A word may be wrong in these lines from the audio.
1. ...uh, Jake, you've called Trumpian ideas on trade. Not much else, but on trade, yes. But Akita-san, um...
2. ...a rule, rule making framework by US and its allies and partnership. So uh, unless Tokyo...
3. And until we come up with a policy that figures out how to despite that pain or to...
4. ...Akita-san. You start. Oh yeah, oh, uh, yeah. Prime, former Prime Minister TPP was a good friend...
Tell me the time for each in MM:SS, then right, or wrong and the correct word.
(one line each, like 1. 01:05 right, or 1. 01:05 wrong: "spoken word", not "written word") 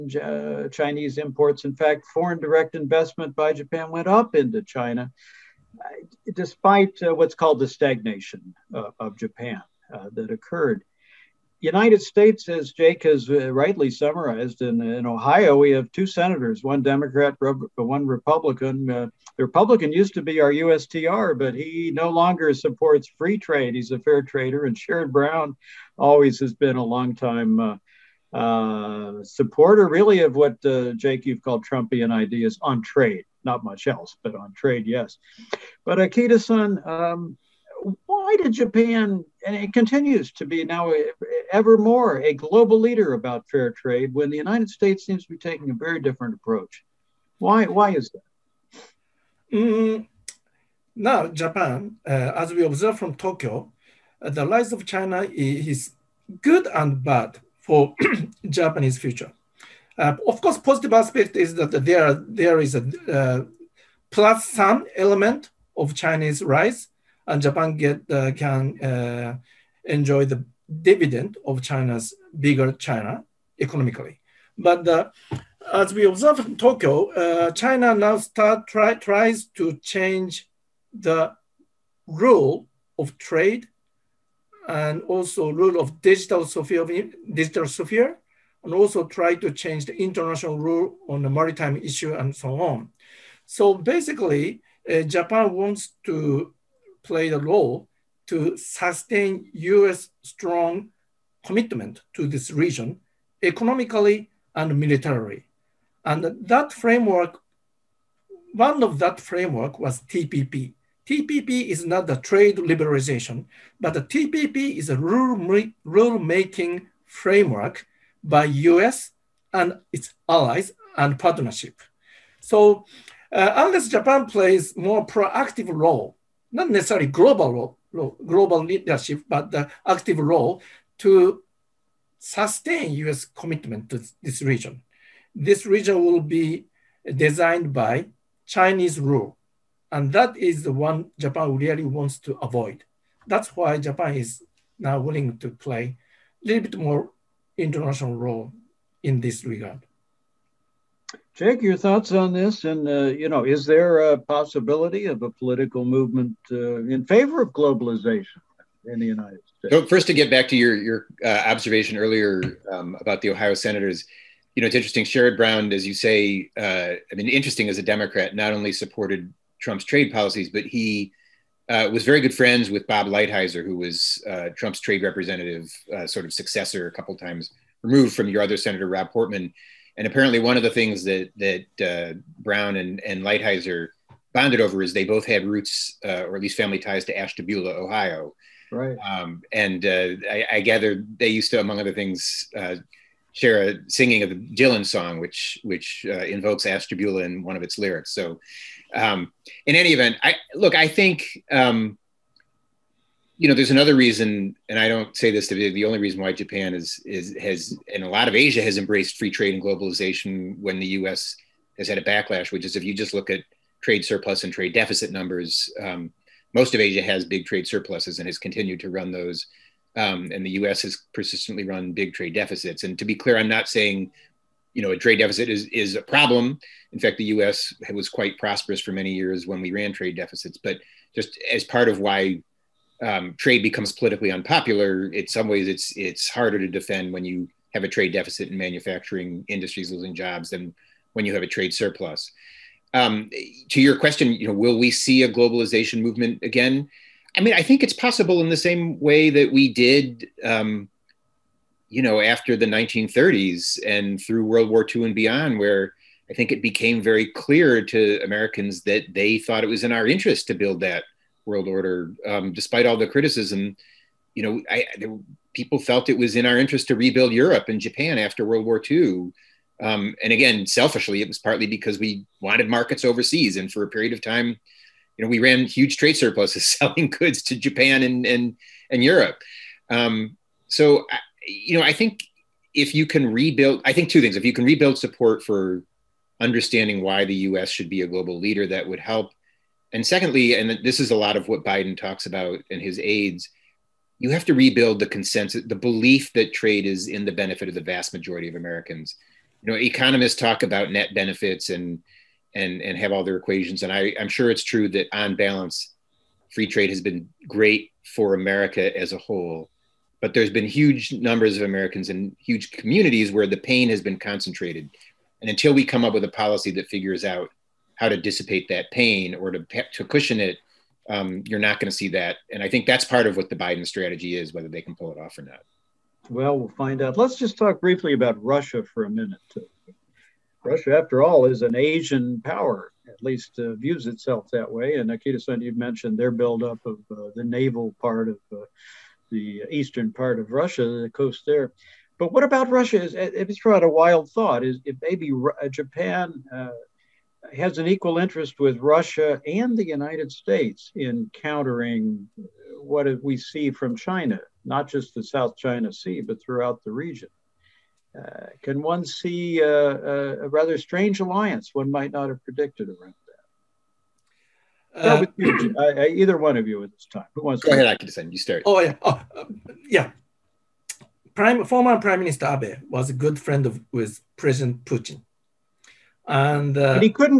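1. 00:30 right
2. 01:54 wrong: "Japan", not "Tokyo"
3. 05:15 wrong: "dissipate", not "despite"
4. 06:08 wrong: "Abe", not "TPP".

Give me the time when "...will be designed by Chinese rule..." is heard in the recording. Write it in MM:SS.
02:16.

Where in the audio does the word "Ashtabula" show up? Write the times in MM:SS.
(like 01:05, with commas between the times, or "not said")
03:07, 03:16.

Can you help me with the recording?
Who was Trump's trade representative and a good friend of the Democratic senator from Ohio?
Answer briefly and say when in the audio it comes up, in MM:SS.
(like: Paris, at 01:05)
Bob Lighthizer, at 02:52.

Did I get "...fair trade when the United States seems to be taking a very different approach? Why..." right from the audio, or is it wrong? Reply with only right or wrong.
right.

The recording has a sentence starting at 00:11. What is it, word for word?
United States, as Jake has uh, rightly summarized, in, in Ohio, we have two senators, one Democrat, one Republican.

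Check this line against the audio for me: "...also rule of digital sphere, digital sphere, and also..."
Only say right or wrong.
right.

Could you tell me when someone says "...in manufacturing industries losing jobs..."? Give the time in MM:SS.
03:58.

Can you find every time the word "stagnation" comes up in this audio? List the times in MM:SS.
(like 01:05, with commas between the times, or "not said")
00:07.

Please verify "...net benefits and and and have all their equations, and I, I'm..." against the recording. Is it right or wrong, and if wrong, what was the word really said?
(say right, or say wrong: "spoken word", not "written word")
right.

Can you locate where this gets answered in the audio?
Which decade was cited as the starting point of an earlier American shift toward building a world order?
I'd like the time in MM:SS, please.
04:12.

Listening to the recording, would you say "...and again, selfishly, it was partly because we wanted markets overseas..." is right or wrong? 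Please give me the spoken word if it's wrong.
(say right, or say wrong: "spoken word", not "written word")
right.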